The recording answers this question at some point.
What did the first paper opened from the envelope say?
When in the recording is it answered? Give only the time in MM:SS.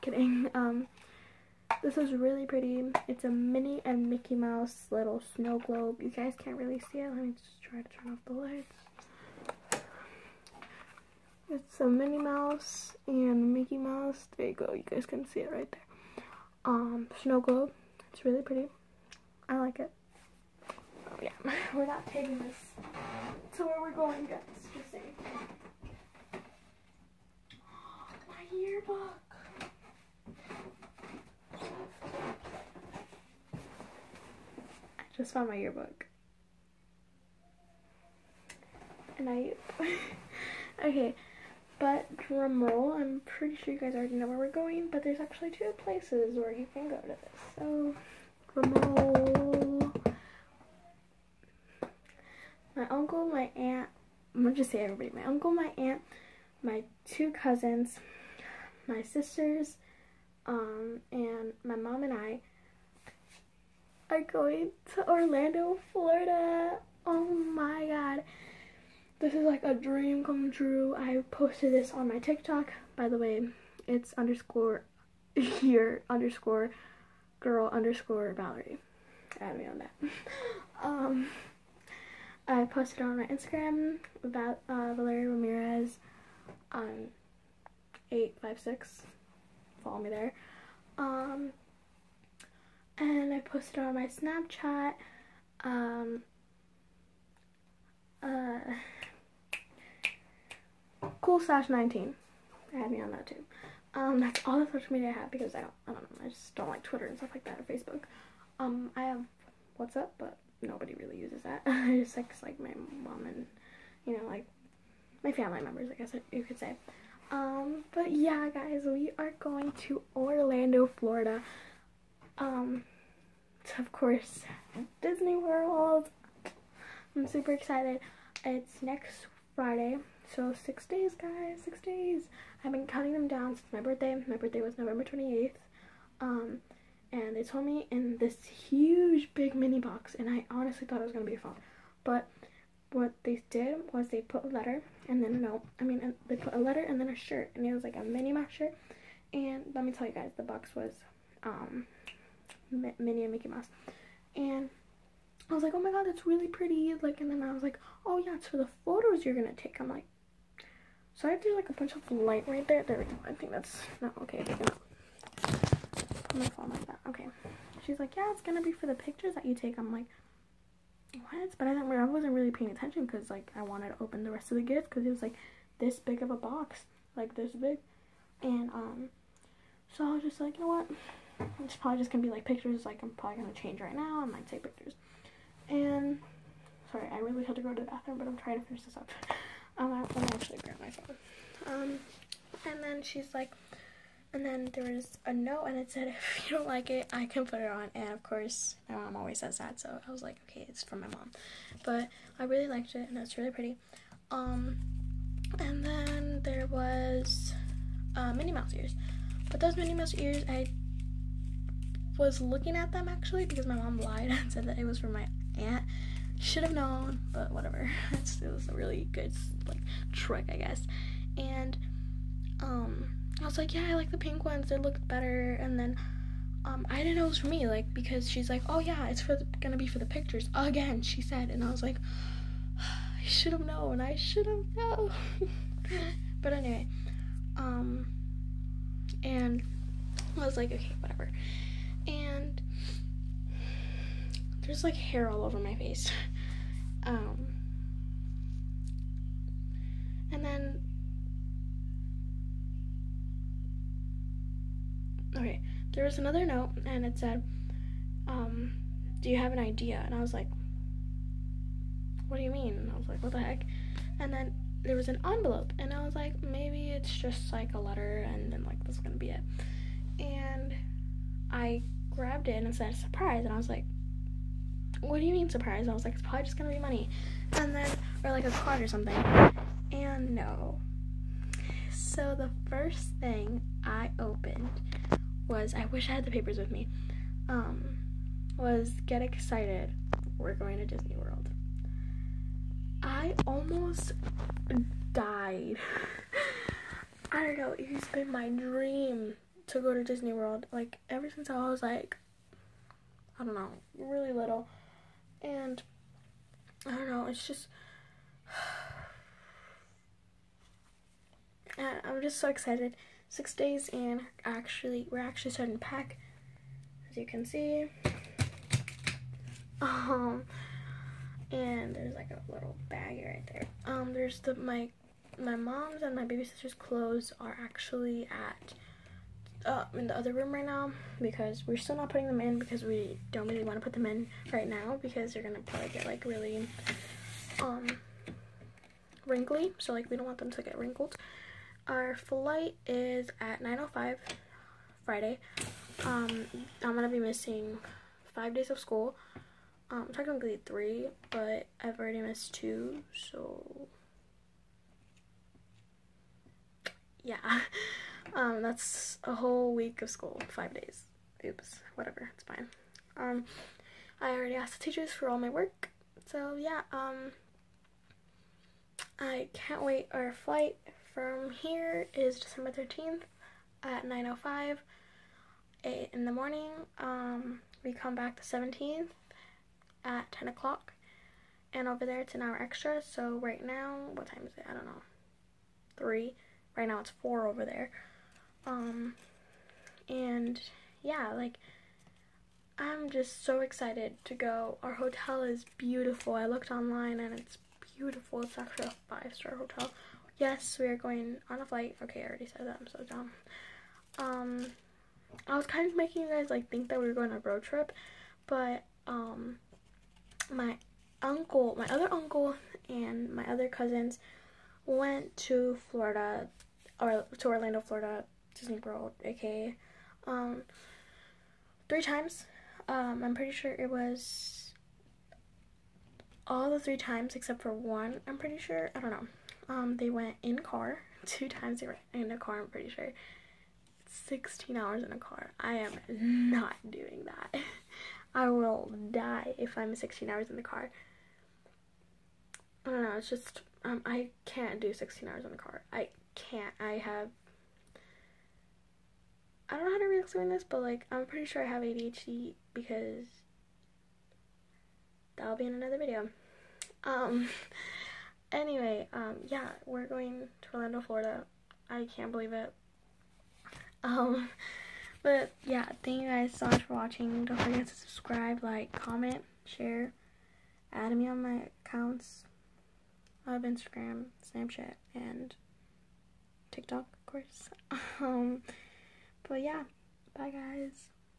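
04:49.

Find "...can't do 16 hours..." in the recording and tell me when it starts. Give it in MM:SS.
07:24.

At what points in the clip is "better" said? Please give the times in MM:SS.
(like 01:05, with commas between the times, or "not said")
03:45.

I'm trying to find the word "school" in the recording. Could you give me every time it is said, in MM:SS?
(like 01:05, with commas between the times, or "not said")
05:48, 06:00.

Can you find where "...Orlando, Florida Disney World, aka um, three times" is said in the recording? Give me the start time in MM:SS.
06:57.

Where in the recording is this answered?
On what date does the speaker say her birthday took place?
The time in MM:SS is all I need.
02:14.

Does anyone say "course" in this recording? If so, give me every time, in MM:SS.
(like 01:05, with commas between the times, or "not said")
02:03, 03:18, 07:57.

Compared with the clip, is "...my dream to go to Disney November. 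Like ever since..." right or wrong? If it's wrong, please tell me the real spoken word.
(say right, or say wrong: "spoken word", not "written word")
wrong: "World", not "November".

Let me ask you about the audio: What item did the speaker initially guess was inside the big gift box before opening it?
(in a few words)
A phone.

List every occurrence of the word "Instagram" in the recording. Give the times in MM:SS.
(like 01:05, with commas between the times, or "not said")
01:23, 07:53.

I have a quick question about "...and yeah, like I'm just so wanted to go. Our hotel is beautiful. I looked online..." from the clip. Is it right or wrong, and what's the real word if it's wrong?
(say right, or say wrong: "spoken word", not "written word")
wrong: "excited", not "wanted".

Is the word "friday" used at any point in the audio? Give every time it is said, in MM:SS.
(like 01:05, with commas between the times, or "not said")
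02:09, 05:45.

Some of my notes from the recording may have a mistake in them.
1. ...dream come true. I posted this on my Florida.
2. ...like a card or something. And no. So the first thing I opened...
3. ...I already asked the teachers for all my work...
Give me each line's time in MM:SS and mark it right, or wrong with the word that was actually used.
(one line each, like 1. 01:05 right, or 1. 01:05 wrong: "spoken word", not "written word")
1. 01:09 wrong: "TikTok", not "Florida"
2. 04:38 right
3. 06:04 right.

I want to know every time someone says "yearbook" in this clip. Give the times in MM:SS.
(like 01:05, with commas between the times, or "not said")
00:28, 00:35.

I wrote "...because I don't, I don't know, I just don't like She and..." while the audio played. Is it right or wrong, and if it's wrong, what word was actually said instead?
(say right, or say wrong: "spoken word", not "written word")
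wrong: "Twitter", not "She".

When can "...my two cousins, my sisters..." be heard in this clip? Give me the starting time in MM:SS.
00:56.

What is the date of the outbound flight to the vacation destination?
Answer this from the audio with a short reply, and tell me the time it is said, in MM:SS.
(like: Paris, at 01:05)
December 13th, at 06:12.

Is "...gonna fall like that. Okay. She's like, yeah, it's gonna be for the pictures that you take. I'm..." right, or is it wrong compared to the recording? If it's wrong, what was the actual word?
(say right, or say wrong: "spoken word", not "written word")
right.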